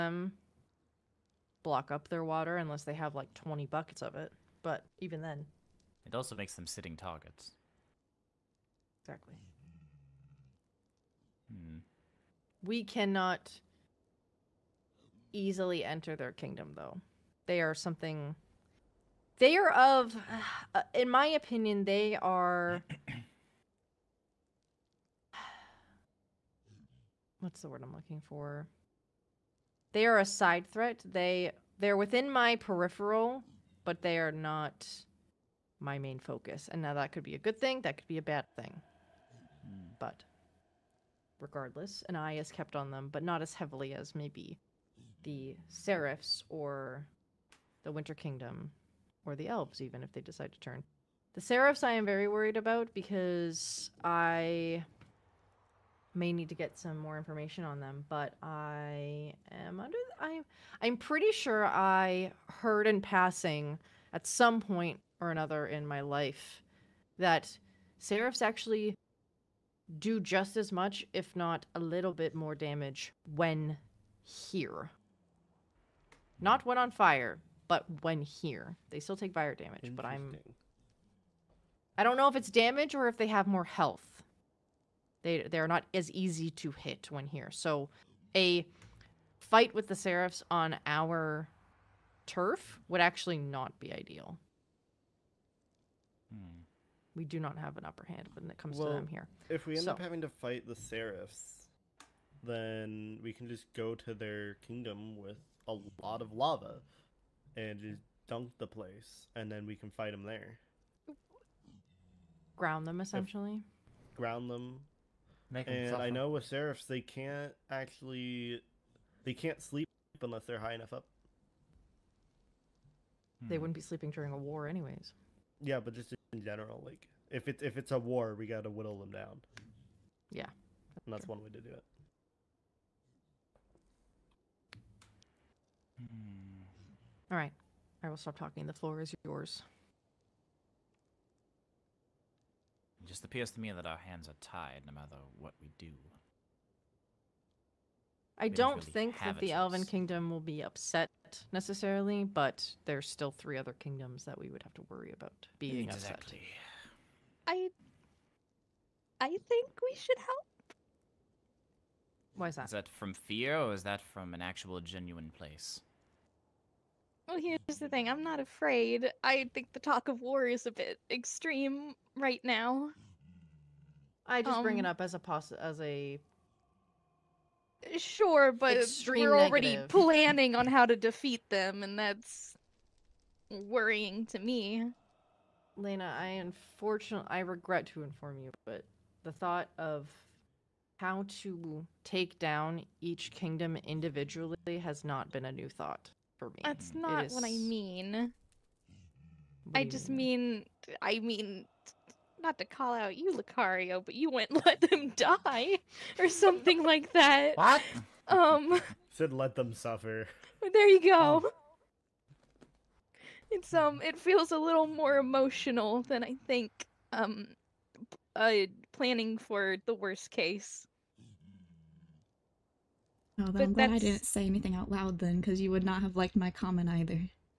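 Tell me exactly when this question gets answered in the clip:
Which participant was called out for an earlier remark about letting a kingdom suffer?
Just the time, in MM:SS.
03:23.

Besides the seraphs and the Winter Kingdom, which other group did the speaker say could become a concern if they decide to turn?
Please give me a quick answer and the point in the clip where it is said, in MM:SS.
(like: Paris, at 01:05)
the elves, at 00:49.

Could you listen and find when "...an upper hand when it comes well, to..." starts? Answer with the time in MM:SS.
01:37.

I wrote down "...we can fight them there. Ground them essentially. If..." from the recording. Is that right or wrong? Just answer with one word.
right.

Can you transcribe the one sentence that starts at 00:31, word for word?
They they're within my peripheral, but they are not my main focus.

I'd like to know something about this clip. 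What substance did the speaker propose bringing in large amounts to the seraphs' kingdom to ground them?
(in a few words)
lava.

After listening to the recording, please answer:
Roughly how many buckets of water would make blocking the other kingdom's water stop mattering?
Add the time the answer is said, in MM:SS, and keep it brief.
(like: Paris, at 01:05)
20, at 00:03.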